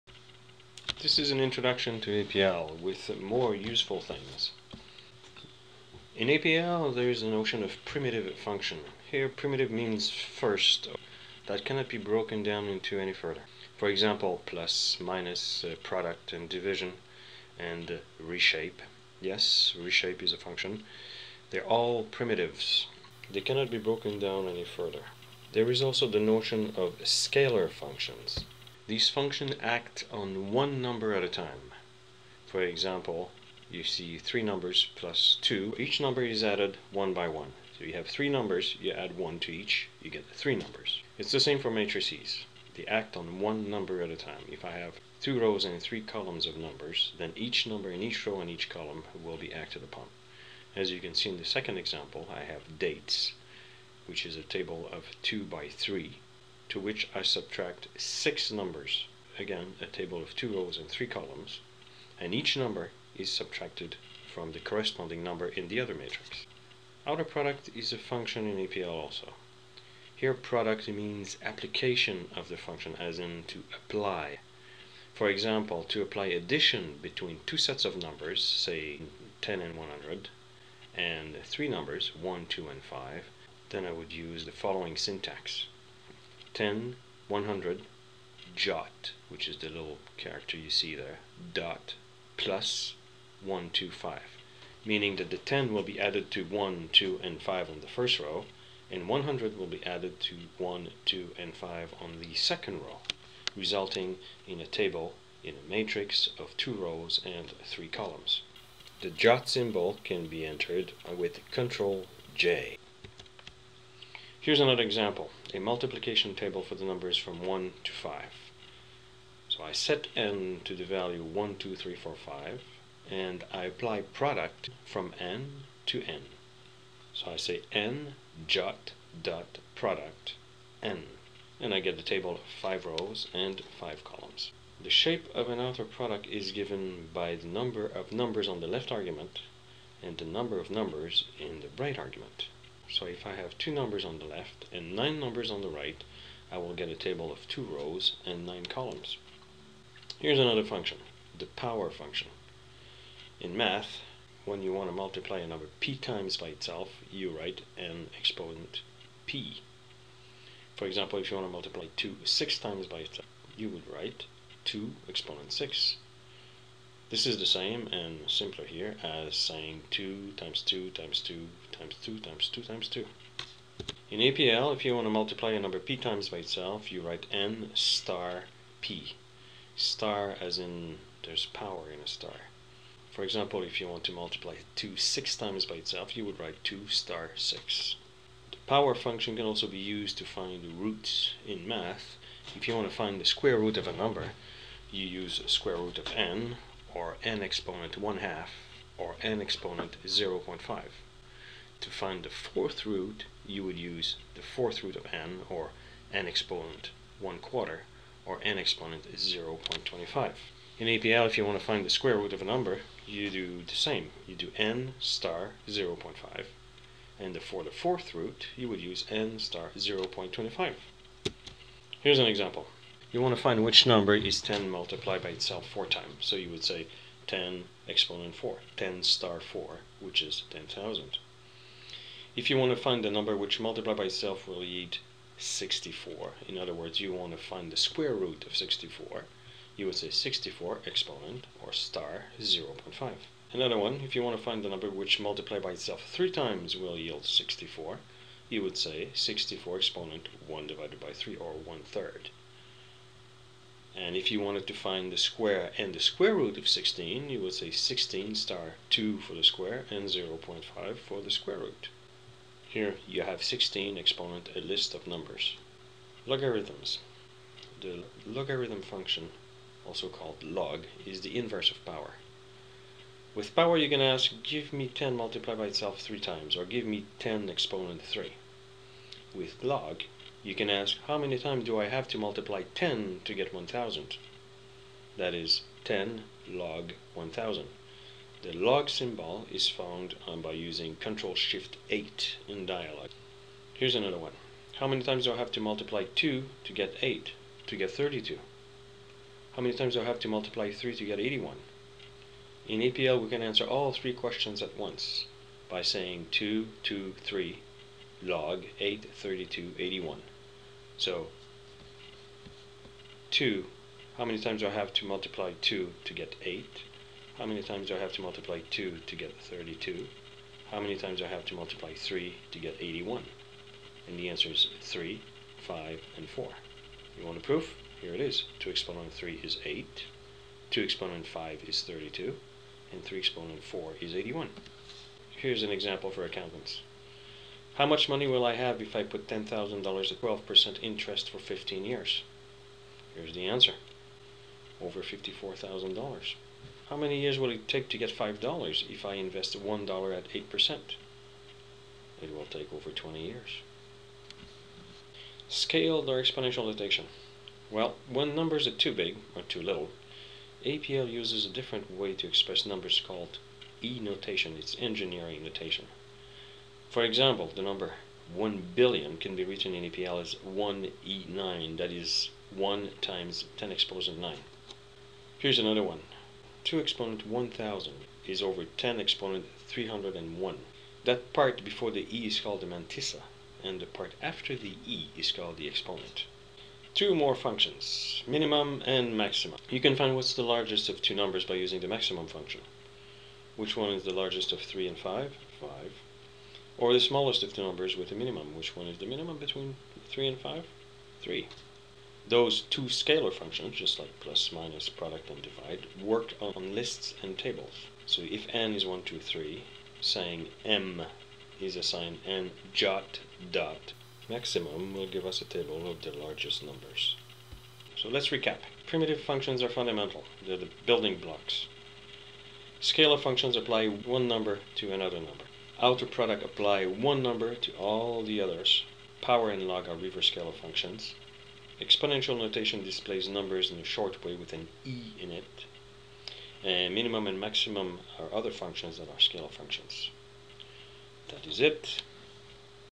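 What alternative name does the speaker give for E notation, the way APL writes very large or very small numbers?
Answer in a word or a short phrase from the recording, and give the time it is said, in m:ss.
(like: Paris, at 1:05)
engineering notation, at 6:04.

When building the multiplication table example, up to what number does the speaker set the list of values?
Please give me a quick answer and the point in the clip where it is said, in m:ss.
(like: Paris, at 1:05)
5, at 2:01.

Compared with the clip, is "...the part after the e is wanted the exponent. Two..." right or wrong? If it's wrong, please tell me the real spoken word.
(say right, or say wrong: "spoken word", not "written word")
wrong: "called", not "wanted".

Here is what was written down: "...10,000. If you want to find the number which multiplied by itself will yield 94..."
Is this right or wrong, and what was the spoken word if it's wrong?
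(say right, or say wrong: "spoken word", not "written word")
wrong: "64", not "94".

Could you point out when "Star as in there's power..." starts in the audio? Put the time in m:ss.
2:59.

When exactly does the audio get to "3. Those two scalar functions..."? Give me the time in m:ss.
6:41.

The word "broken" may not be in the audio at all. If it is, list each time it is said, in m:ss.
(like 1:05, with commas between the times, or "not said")
0:11, 0:23.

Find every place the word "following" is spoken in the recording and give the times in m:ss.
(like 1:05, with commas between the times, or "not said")
1:24.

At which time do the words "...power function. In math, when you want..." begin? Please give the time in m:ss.
2:31.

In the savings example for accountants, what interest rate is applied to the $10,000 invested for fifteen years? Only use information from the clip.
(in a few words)
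12%.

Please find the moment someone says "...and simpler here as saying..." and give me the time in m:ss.
2:47.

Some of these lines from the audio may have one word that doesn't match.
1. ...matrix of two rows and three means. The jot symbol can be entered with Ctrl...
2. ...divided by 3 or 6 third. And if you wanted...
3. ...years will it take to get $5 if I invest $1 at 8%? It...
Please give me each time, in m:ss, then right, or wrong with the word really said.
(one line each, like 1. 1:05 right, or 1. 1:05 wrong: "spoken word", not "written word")
1. 1:45 wrong: "columns", not "means"
2. 4:10 wrong: "1", not "6"
3. 5:47 right.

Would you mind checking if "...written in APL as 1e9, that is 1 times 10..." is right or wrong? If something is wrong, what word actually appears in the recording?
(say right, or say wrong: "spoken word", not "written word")
right.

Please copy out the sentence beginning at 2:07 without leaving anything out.
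So I say n dot dot product n, and I get the table of 5 rows and 5 columns.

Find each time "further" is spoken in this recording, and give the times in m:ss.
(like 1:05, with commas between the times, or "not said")
0:13, 0:24.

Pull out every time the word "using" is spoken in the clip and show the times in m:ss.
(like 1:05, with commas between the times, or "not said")
4:50, 6:31.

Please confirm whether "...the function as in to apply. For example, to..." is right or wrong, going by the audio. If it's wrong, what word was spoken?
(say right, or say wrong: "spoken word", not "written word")
right.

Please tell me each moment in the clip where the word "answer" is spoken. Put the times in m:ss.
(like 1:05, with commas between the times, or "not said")
5:03, 5:24, 5:43.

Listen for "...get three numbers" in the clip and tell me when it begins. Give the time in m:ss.
0:40.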